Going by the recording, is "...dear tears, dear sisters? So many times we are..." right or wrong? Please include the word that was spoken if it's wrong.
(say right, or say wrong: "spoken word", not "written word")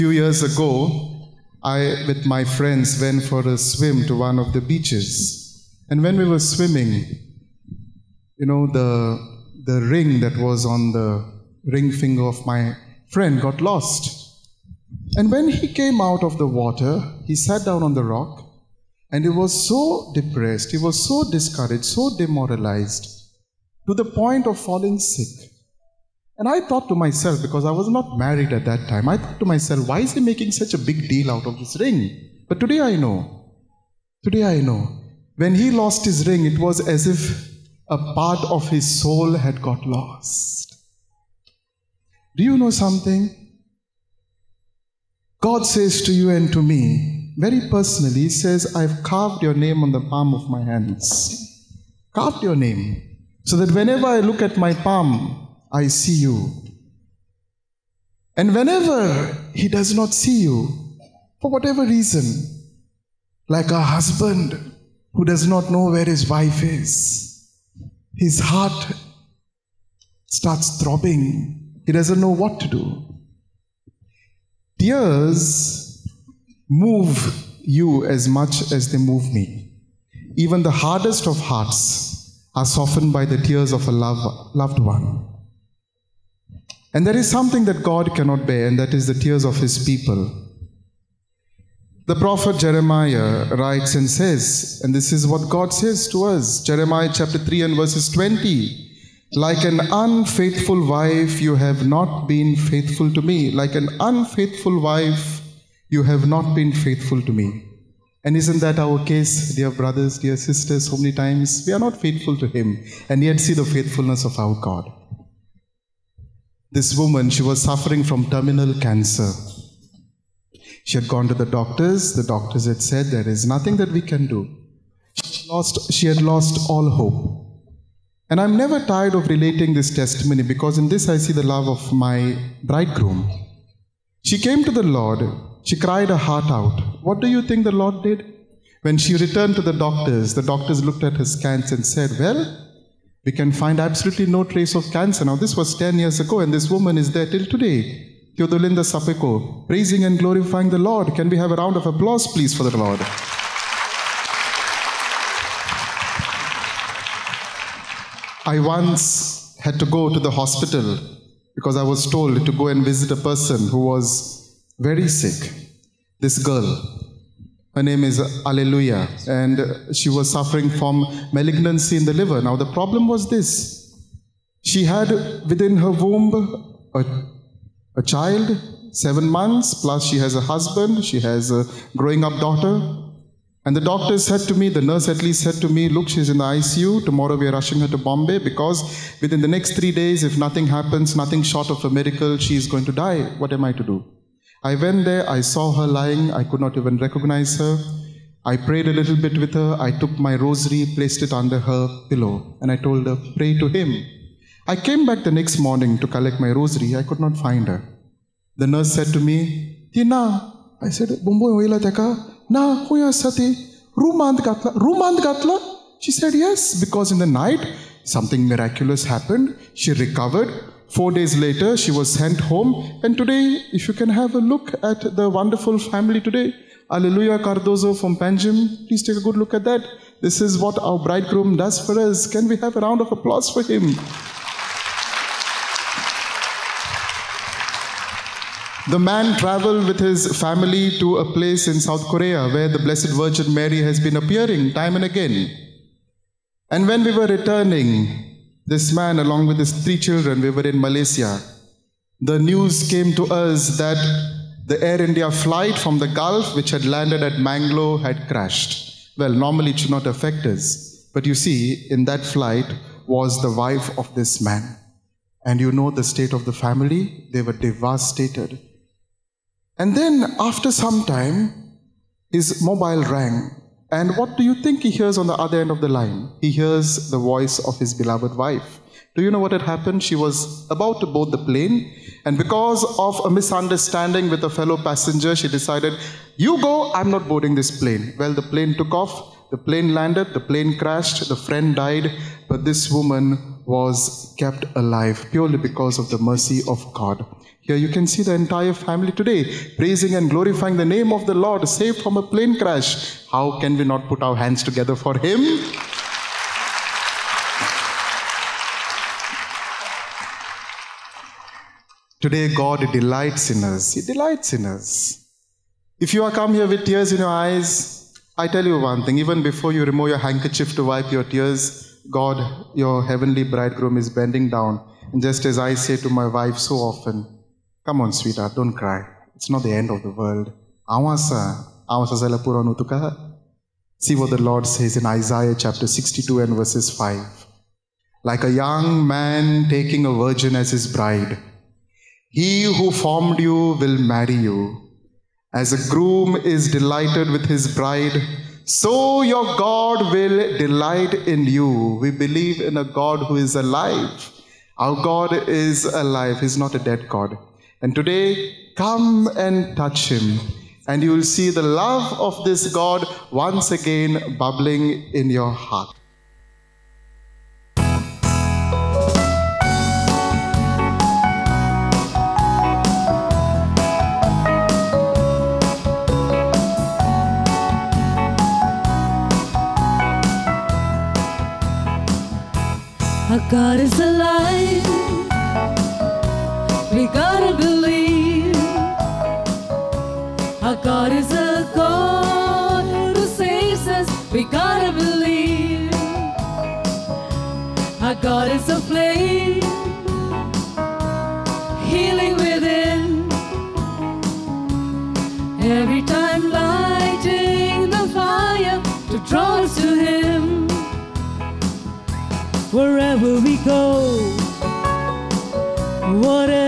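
wrong: "brothers", not "tears".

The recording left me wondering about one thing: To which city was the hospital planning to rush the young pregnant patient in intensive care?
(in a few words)
Bombay.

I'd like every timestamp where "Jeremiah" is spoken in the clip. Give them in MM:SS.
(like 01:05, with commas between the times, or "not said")
01:32, 01:36.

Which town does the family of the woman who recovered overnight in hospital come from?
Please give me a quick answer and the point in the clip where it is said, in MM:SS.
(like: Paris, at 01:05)
Panjim, at 03:48.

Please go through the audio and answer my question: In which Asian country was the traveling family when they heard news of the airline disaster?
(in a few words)
Malaysia.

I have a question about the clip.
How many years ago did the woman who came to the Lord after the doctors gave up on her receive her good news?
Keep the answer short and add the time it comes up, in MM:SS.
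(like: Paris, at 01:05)
10, at 02:25.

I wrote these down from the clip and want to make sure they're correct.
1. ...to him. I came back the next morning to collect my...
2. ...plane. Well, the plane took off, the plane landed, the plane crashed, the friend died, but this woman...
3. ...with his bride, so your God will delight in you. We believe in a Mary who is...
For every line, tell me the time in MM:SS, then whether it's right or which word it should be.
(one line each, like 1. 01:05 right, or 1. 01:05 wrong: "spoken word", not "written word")
1. 03:23 right
2. 04:47 right
3. 05:47 wrong: "God", not "Mary".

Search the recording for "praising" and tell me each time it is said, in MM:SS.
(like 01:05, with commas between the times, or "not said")
02:29, 04:59.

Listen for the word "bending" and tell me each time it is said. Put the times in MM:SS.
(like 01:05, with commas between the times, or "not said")
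05:24.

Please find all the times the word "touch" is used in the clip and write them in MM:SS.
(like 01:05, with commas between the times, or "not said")
05:59.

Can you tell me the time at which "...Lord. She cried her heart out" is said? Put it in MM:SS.
02:14.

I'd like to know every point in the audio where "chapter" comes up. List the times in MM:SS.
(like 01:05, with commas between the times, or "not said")
01:37, 05:35.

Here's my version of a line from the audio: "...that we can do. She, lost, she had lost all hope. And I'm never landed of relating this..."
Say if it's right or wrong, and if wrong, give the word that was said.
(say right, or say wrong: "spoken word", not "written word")
wrong: "tired", not "landed".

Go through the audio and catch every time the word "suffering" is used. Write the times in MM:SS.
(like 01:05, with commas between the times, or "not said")
01:57, 02:50.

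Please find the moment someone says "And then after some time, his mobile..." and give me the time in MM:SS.
04:29.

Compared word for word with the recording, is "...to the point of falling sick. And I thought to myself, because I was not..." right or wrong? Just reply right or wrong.
right.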